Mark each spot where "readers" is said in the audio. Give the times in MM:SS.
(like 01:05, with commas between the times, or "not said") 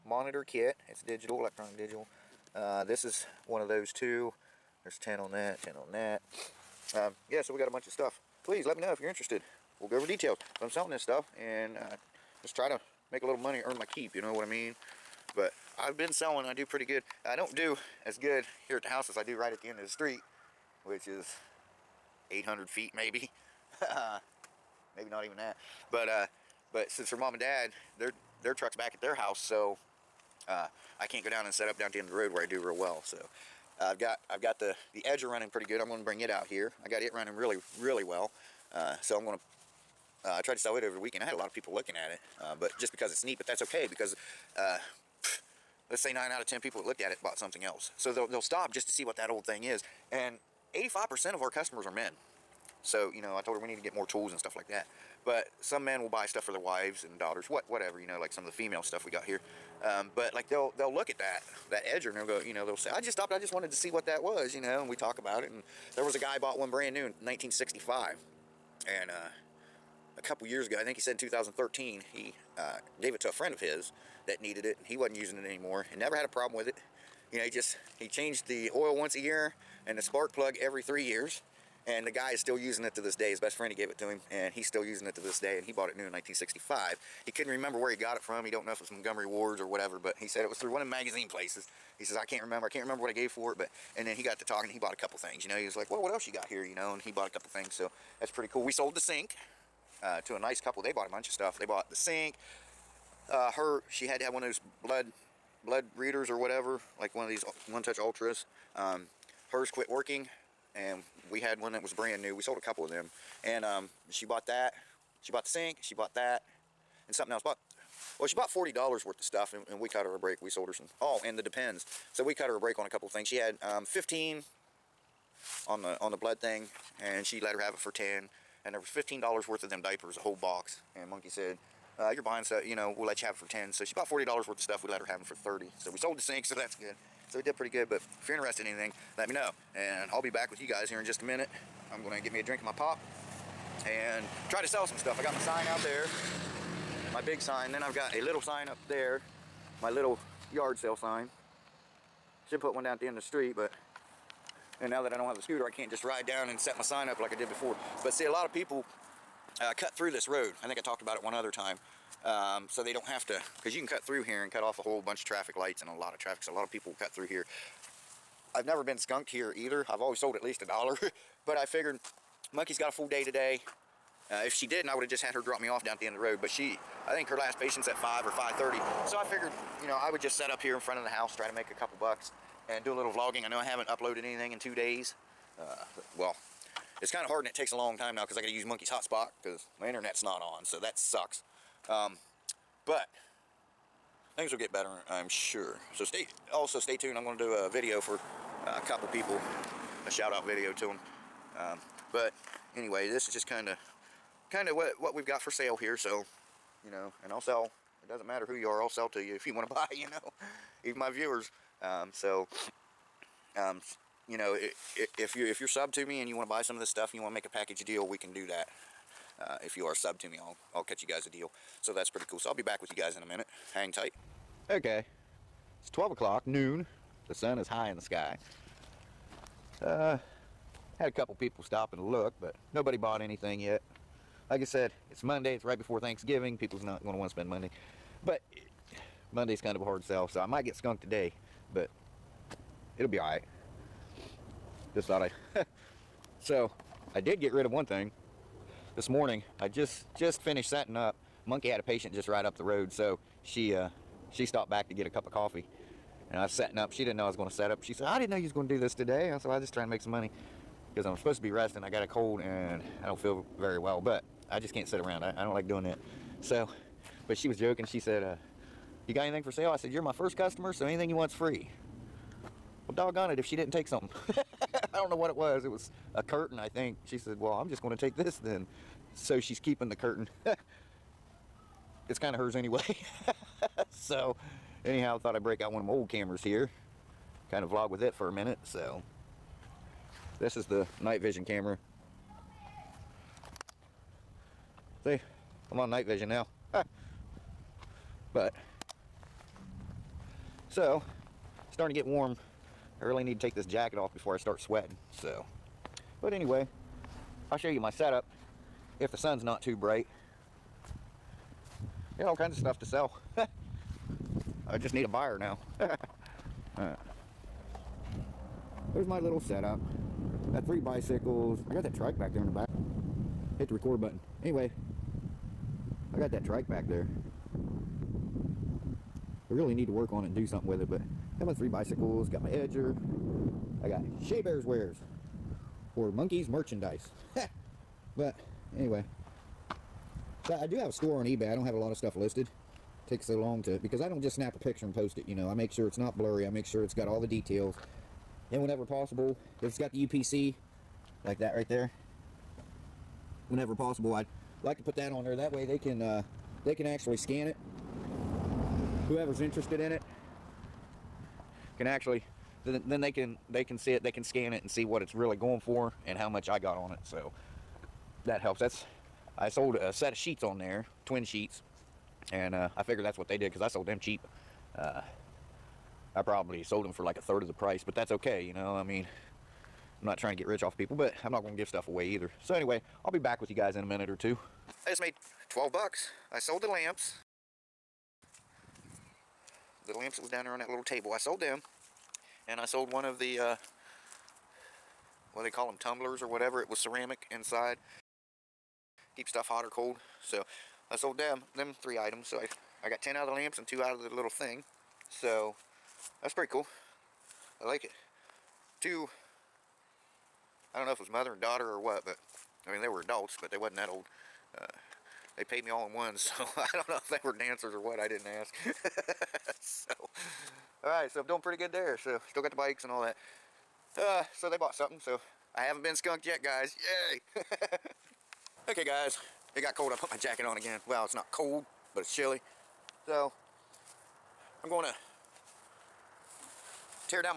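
01:45.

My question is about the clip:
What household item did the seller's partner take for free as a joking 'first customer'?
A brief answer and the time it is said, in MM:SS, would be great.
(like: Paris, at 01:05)
A curtain, at 04:36.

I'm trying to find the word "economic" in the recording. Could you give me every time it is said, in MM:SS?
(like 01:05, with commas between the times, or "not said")
not said.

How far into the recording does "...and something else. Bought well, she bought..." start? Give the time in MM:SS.
01:57.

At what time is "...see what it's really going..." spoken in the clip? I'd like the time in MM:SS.
06:04.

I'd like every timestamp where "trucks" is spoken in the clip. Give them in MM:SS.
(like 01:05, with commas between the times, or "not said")
00:28.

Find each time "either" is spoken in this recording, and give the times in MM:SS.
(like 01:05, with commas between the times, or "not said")
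02:49, 06:22.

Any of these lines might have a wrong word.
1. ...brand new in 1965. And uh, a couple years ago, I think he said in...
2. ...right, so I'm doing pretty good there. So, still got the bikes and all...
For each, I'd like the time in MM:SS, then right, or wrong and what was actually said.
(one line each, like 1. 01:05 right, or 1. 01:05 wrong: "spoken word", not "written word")
1. 01:06 right
2. 07:00 right.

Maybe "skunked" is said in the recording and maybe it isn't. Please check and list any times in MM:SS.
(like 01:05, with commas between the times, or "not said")
02:48, 04:00, 07:05.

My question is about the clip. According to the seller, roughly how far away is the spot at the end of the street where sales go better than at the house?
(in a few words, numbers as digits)
800 feet.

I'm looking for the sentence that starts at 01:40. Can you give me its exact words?
They bought a bunch of stuff.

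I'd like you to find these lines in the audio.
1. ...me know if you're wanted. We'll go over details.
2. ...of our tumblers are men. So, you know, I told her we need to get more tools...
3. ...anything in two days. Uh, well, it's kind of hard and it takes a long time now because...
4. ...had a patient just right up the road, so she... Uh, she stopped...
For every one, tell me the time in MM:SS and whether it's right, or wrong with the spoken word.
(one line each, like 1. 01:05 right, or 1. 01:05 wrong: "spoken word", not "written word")
1. 00:08 wrong: "interested", not "wanted"
2. 00:51 wrong: "customers", not "tumblers"
3. 03:04 right
4. 04:11 right.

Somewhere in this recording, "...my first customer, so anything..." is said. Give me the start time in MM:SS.
04:30.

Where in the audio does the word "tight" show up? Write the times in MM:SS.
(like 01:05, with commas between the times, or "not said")
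03:43.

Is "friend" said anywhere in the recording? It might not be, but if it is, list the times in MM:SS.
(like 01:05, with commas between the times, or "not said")
01:13, 01:23.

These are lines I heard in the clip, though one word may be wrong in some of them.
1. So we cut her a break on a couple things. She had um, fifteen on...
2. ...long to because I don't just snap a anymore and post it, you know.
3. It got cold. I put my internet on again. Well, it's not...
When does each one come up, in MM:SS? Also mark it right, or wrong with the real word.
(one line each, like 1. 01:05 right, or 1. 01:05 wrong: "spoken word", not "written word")
1. 02:02 right
2. 05:43 wrong: "picture", not "anymore"
3. 07:09 wrong: "jacket", not "internet".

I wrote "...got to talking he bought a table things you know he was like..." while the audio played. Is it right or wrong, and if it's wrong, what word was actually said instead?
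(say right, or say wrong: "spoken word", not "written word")
wrong: "couple", not "table".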